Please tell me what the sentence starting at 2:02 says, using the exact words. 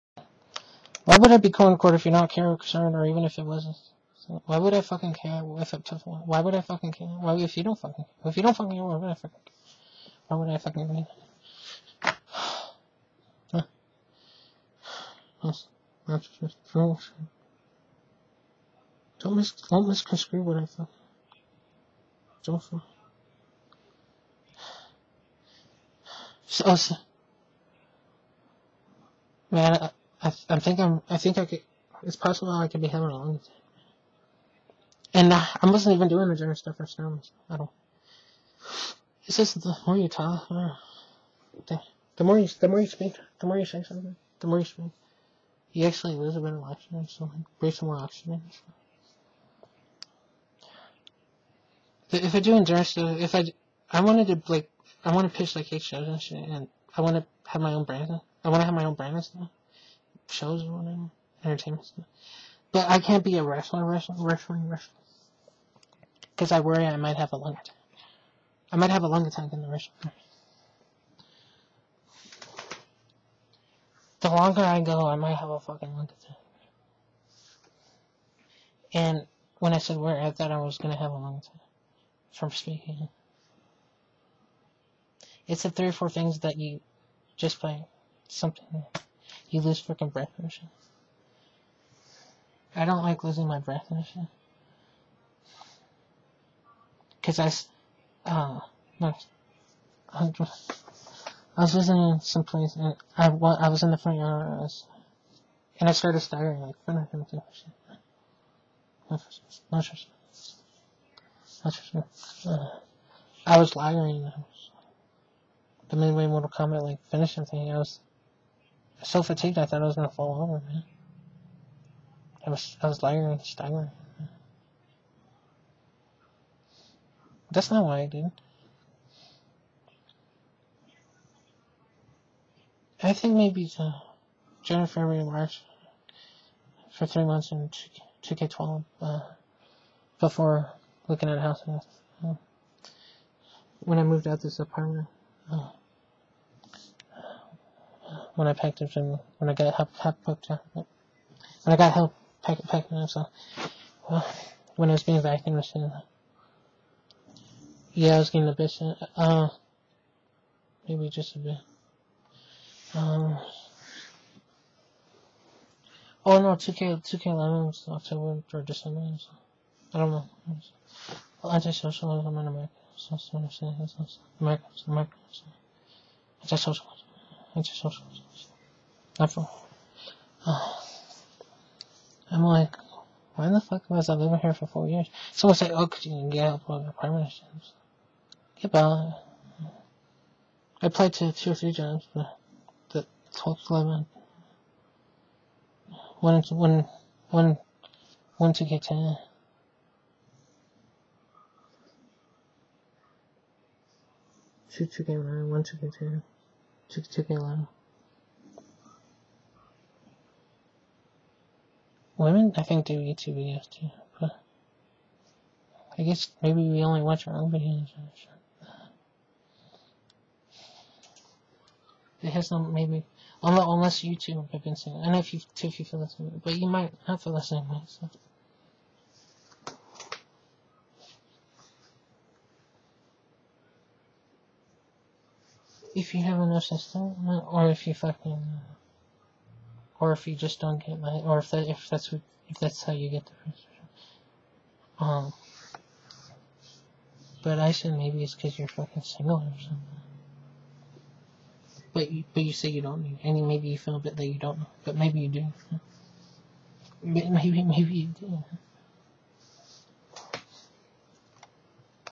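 I was I was lagging and staggering.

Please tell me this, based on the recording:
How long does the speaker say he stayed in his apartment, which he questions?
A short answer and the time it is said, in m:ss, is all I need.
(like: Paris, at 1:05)
4 years, at 3:04.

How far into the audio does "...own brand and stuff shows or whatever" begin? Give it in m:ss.
0:58.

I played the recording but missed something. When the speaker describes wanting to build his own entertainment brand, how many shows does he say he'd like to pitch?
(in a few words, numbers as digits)
8.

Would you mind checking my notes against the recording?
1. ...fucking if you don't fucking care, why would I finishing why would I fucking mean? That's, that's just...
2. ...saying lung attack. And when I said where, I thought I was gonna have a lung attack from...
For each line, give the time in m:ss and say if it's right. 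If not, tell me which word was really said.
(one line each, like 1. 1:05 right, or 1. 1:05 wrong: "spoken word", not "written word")
1. 0:07 wrong: "fucking", not "finishing"
2. 1:15 wrong: "fucking", not "saying".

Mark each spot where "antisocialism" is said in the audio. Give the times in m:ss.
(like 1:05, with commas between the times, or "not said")
2:51, 2:56.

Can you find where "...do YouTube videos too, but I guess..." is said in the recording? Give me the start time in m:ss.
3:32.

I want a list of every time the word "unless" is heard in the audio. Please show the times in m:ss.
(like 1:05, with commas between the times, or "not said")
3:43.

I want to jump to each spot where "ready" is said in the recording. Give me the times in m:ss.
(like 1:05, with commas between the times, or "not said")
not said.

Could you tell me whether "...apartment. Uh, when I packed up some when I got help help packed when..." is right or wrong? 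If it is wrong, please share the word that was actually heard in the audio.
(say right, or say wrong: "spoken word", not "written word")
right.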